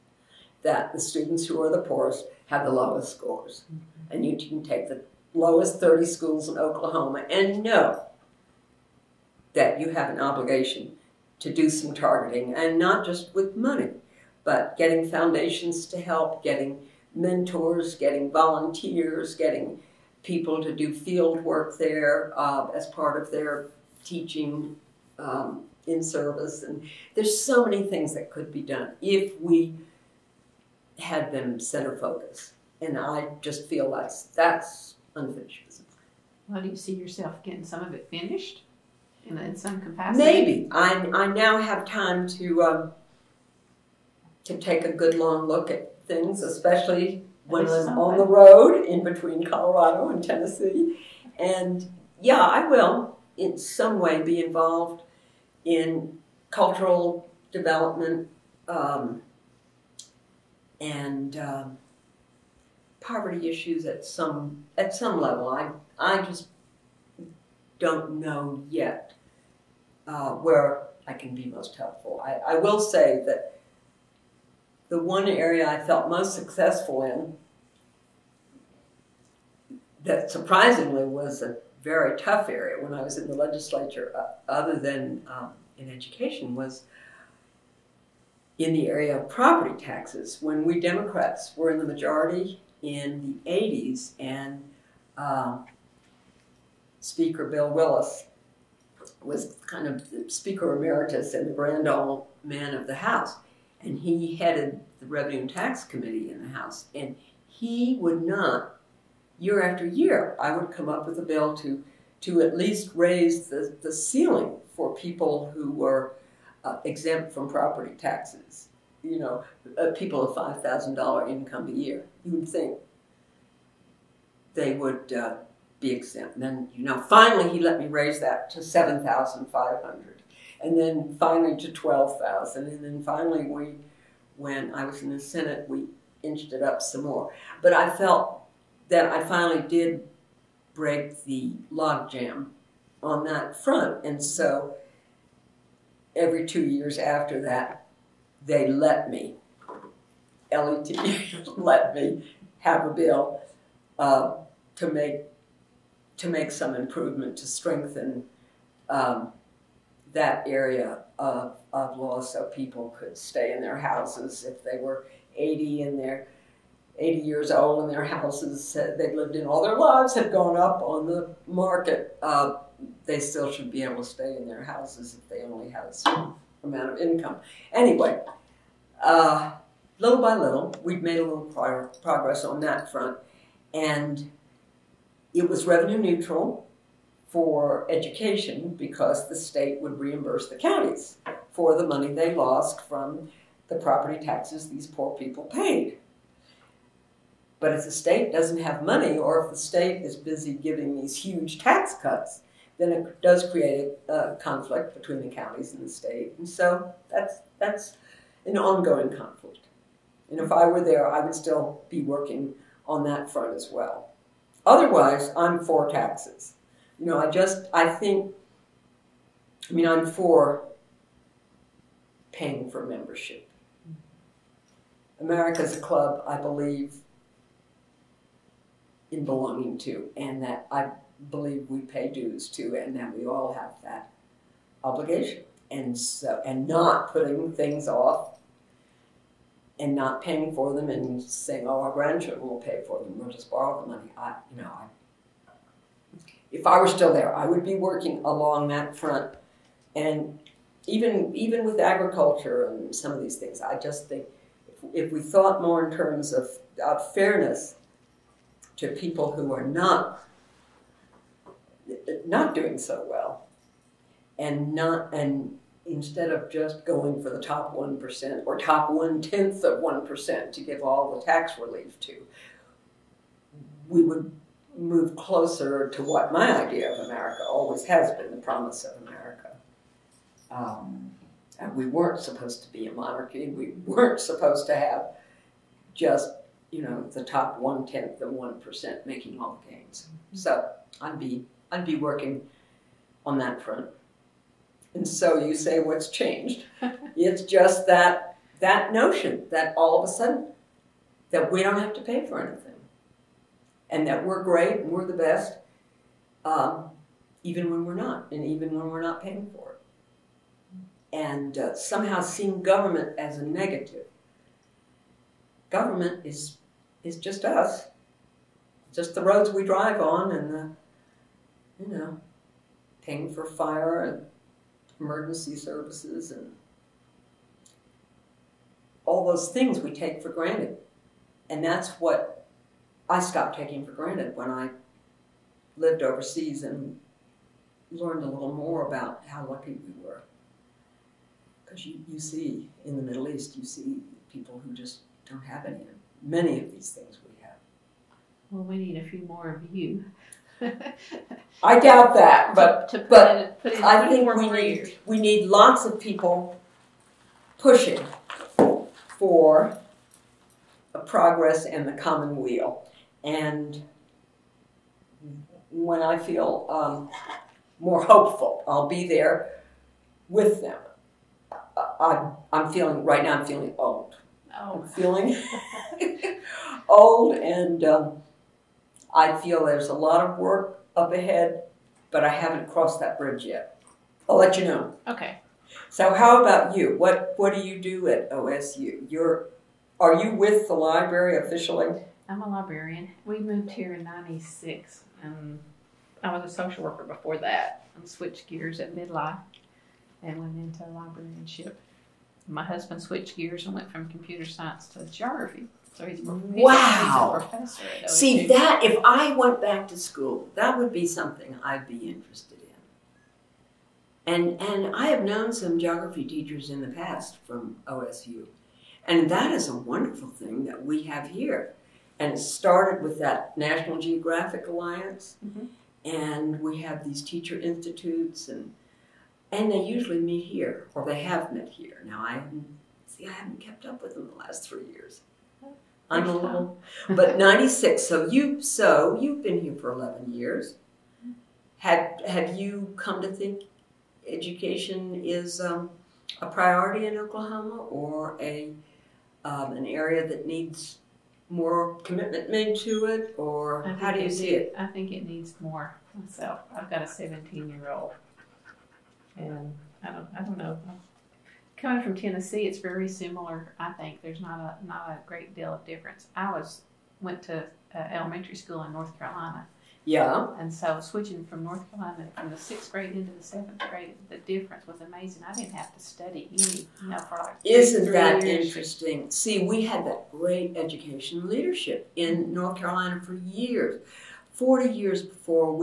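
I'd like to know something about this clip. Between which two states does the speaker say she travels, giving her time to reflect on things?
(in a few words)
Colorado and Tennessee.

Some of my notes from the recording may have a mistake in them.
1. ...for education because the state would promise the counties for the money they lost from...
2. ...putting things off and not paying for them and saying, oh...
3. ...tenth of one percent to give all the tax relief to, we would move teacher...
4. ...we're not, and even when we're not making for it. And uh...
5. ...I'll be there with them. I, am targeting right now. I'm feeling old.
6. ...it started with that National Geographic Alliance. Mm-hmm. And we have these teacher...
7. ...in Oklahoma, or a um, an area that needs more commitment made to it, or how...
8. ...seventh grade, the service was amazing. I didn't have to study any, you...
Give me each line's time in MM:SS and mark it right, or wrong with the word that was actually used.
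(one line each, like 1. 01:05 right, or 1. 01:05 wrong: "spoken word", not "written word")
1. 03:07 wrong: "reimburse", not "promise"
2. 03:57 right
3. 04:29 wrong: "closer", not "teacher"
4. 05:07 wrong: "paying", not "making"
5. 06:08 wrong: "feeling", not "targeting"
6. 07:02 right
7. 07:27 right
8. 07:53 wrong: "difference", not "service".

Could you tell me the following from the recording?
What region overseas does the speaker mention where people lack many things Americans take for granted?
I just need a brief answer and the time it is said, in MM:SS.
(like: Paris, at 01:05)
Middle East, at 05:43.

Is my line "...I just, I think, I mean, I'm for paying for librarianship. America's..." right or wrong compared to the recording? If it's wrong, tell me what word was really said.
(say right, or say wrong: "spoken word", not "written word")
wrong: "membership", not "librarianship".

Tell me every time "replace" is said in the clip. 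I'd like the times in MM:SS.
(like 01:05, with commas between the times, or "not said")
not said.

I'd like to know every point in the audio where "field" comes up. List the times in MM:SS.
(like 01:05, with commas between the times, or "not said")
00:20.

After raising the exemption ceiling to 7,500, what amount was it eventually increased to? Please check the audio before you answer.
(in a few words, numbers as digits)
12,000.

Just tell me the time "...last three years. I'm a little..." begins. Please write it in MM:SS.
07:14.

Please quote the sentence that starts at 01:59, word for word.
You know, uh, people of $5,000 income a year.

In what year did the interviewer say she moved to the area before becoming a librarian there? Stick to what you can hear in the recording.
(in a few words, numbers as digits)
1996.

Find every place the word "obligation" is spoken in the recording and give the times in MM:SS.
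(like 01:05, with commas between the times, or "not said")
00:10, 03:54.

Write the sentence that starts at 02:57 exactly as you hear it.
Anyway, uh, little by little, we've made a little pro progress on that front.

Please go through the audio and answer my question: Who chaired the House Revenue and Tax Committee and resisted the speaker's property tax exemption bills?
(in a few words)
Bill Willis.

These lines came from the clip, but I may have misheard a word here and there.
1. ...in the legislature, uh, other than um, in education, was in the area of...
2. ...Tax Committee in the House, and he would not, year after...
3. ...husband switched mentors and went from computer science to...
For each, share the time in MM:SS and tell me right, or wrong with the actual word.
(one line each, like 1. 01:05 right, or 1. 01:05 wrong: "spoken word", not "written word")
1. 01:23 right
2. 01:45 right
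3. 06:42 wrong: "gears", not "mentors".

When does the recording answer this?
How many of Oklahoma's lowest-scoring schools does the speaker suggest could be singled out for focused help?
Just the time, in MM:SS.
00:05.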